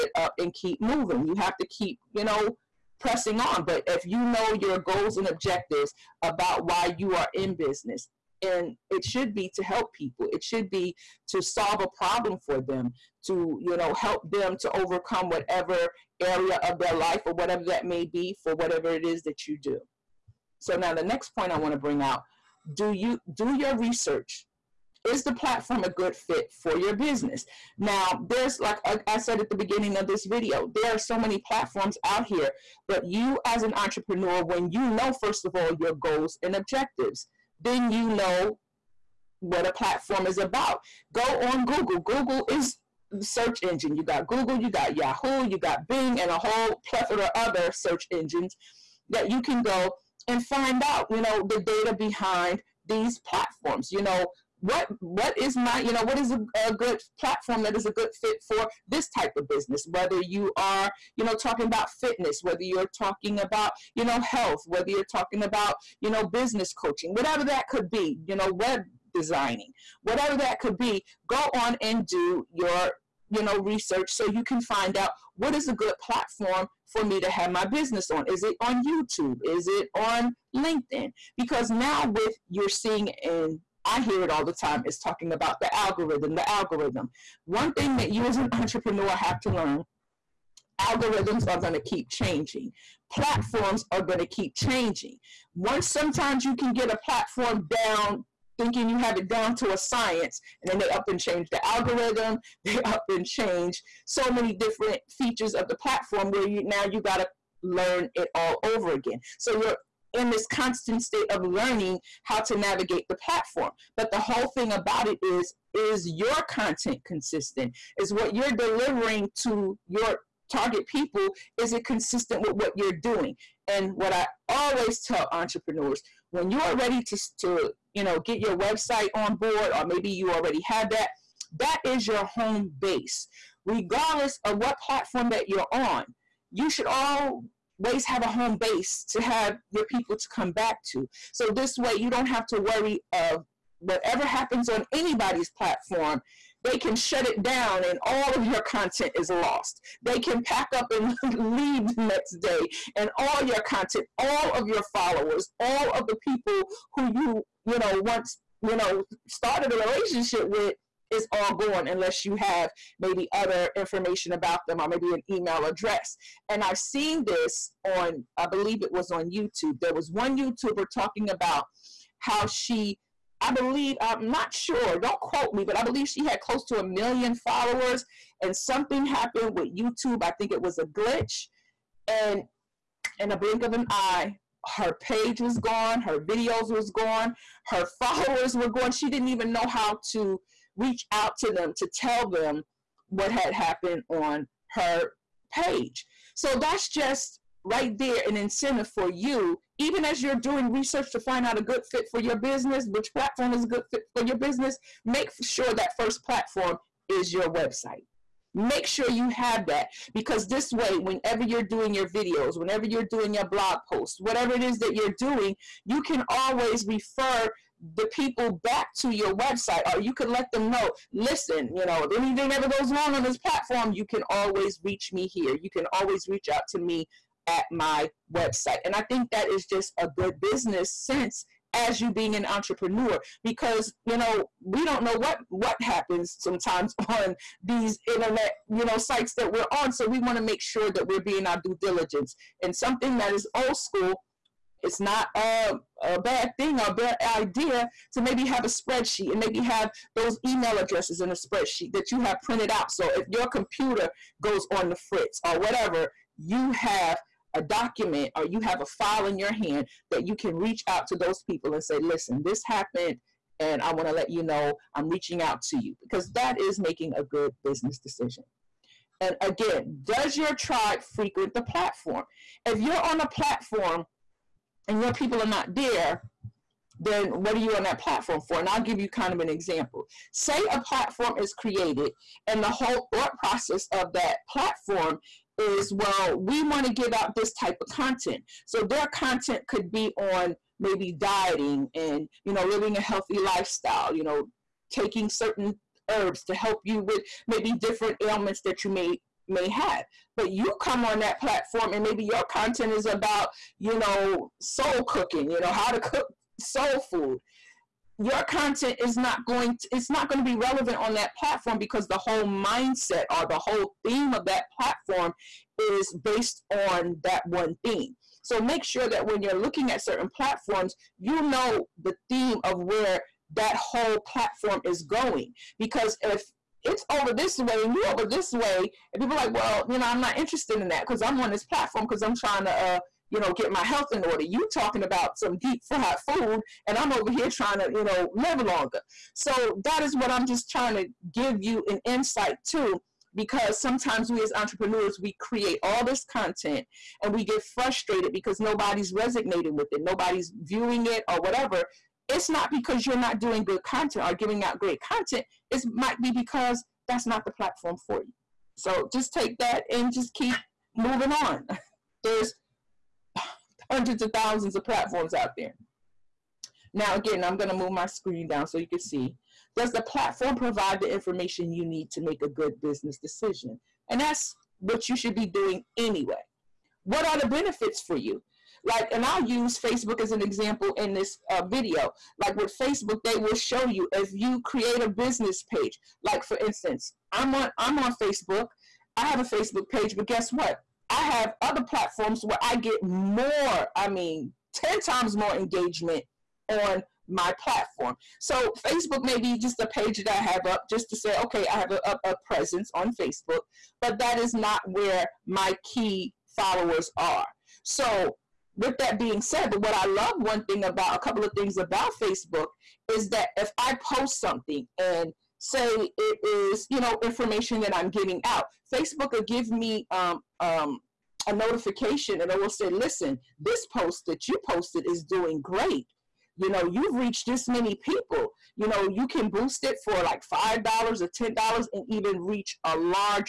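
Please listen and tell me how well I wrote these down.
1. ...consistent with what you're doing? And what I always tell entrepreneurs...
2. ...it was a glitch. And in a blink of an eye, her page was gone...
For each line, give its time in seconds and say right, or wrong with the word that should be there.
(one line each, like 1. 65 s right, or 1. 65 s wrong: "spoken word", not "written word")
1. 121 s right
2. 180 s right.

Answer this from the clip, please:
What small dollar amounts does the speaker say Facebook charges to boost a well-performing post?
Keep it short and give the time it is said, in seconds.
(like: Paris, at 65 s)
$5 or $10, at 430 s.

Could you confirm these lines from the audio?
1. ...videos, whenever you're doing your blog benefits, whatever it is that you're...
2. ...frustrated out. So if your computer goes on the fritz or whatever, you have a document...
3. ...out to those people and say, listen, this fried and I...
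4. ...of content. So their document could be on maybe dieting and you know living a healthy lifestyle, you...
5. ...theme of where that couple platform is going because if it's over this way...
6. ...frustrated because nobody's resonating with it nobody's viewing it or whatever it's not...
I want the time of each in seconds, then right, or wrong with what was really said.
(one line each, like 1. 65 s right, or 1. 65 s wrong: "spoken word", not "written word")
1. 212 s wrong: "posts", not "benefits"
2. 252 s wrong: "printed", not "frustrated"
3. 260 s wrong: "happened", not "fried"
4. 287 s wrong: "content", not "document"
5. 322 s wrong: "whole", not "couple"
6. 347 s right.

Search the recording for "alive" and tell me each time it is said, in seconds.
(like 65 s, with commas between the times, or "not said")
not said.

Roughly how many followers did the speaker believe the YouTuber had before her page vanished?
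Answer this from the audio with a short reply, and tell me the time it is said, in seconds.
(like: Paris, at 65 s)
A million, at 176 s.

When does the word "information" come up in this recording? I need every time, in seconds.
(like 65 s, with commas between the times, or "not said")
163 s, 371 s, 417 s.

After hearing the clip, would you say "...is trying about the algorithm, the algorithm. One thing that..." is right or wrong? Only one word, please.
wrong.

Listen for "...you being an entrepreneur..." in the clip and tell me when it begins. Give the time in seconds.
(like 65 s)
232 s.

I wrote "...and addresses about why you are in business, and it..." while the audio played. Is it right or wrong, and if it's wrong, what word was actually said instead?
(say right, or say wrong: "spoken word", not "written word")
wrong: "objectives", not "addresses".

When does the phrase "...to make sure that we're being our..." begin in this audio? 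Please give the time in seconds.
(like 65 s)
240 s.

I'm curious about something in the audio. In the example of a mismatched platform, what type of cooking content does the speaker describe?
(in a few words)
Soul food.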